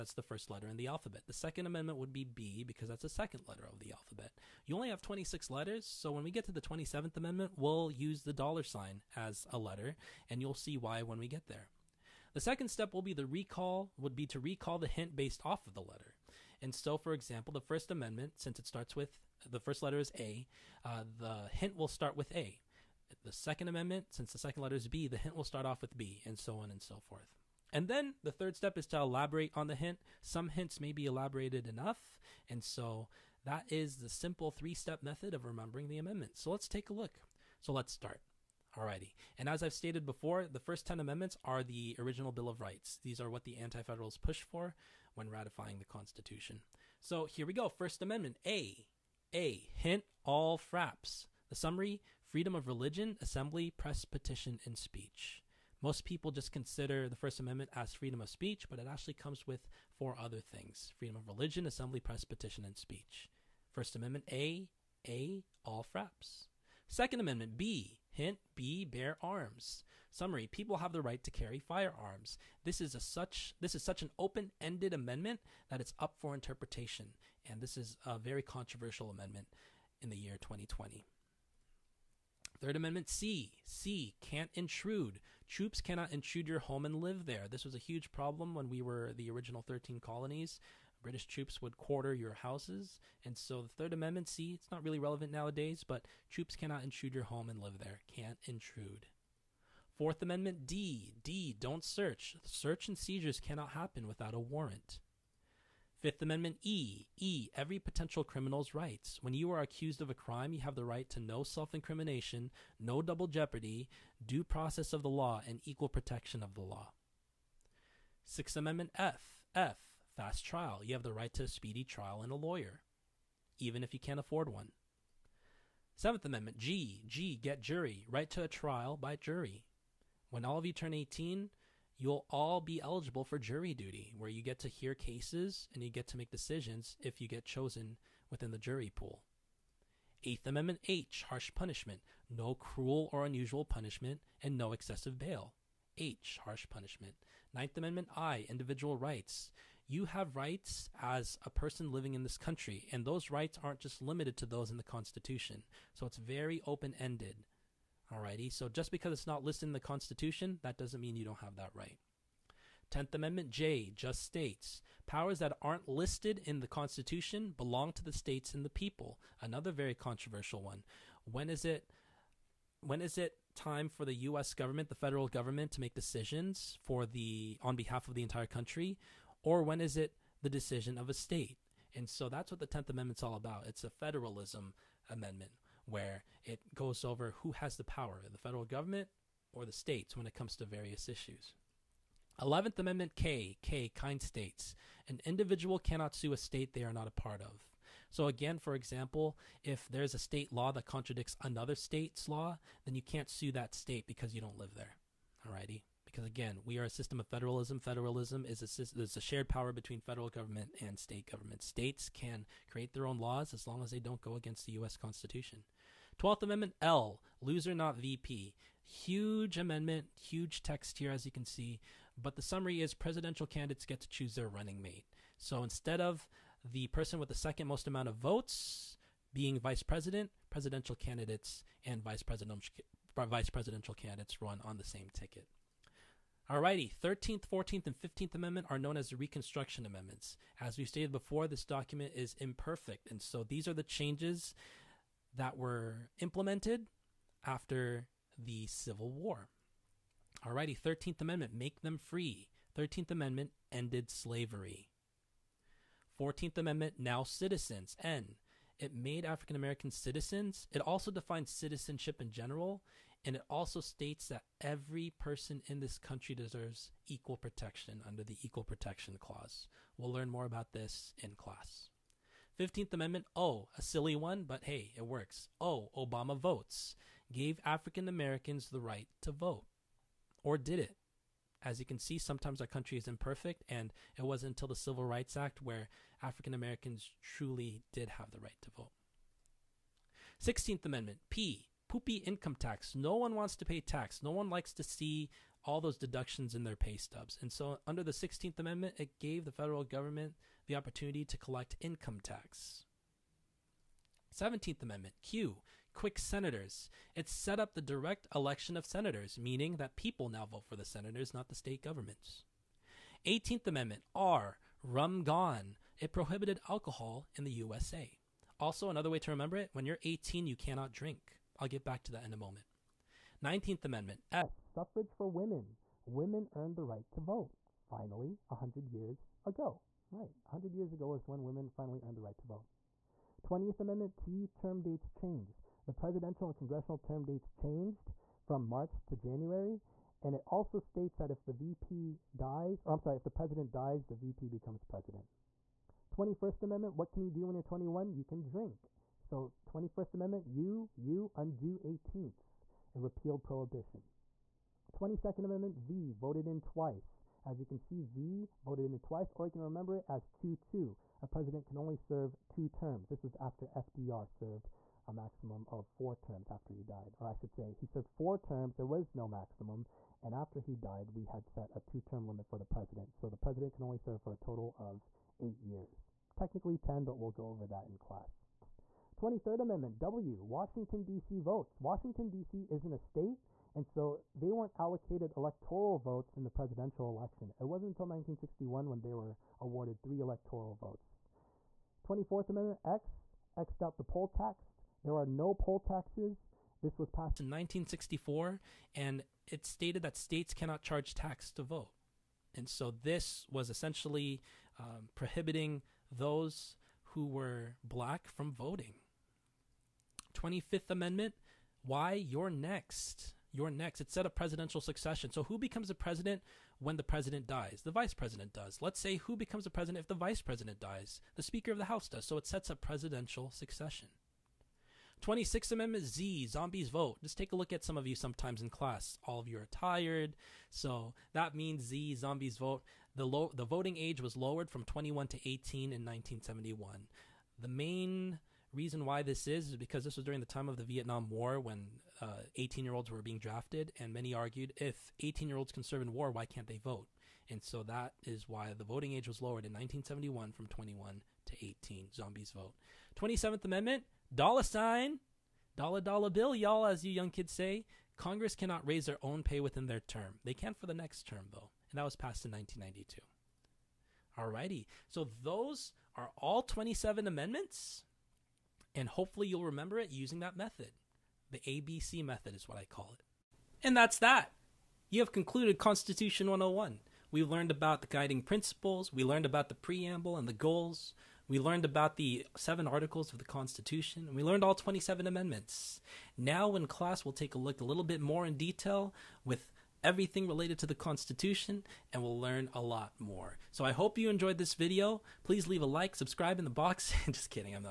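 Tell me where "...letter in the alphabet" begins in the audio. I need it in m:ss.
0:00.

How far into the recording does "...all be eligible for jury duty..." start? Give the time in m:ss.
2:12.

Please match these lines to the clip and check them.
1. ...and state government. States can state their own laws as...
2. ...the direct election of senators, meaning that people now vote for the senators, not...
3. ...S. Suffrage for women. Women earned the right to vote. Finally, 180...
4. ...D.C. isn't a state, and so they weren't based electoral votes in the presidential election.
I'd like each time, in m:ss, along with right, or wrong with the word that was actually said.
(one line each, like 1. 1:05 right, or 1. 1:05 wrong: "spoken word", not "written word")
1. 3:30 wrong: "create", not "state"
2. 5:07 right
3. 5:24 wrong: "100", not "180"
4. 6:22 wrong: "allocated", not "based".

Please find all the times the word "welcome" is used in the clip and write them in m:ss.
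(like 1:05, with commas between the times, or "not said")
not said.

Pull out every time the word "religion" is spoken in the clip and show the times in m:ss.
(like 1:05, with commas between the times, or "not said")
0:52, 1:01.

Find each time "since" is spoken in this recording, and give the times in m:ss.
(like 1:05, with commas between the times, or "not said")
0:18, 0:24.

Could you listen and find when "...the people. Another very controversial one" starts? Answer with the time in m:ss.
2:48.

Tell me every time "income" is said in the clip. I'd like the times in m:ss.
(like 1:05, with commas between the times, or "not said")
4:52, 5:01.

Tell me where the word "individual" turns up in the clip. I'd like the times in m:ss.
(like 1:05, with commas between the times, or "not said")
2:28, 3:15.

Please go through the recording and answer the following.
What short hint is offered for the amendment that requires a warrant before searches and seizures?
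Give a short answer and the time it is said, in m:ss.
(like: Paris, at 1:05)
Don't search, at 1:41.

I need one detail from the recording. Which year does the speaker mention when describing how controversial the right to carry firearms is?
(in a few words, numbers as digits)
2020.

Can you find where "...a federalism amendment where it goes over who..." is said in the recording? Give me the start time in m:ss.
3:03.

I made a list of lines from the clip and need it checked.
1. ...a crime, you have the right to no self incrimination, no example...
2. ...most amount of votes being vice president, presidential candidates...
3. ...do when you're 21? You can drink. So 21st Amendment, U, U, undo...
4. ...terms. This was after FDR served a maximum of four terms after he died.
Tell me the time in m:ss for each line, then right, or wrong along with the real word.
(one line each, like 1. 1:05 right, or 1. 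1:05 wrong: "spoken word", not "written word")
1. 1:50 wrong: "double", not "example"
2. 3:47 right
3. 5:47 right
4. 6:02 right.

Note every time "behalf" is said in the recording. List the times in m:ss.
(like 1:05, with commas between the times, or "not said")
2:57.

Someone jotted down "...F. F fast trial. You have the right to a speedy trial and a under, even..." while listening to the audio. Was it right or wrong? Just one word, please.
wrong.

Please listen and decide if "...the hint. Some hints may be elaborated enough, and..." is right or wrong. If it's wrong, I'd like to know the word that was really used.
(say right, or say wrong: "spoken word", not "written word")
right.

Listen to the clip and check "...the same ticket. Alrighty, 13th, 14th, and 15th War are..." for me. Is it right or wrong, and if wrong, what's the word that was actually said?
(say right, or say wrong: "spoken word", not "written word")
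wrong: "Amendment", not "War".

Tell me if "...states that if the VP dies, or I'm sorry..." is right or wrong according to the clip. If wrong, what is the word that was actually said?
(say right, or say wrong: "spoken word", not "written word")
right.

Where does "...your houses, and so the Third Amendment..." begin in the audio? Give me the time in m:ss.
1:32.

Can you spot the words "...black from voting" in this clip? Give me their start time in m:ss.
6:47.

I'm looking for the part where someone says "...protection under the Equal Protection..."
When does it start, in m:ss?
4:27.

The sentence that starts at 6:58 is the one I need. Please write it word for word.
Let's say who becomes the president if the vice president dies?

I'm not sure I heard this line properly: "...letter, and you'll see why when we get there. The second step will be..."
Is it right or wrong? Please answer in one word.
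right.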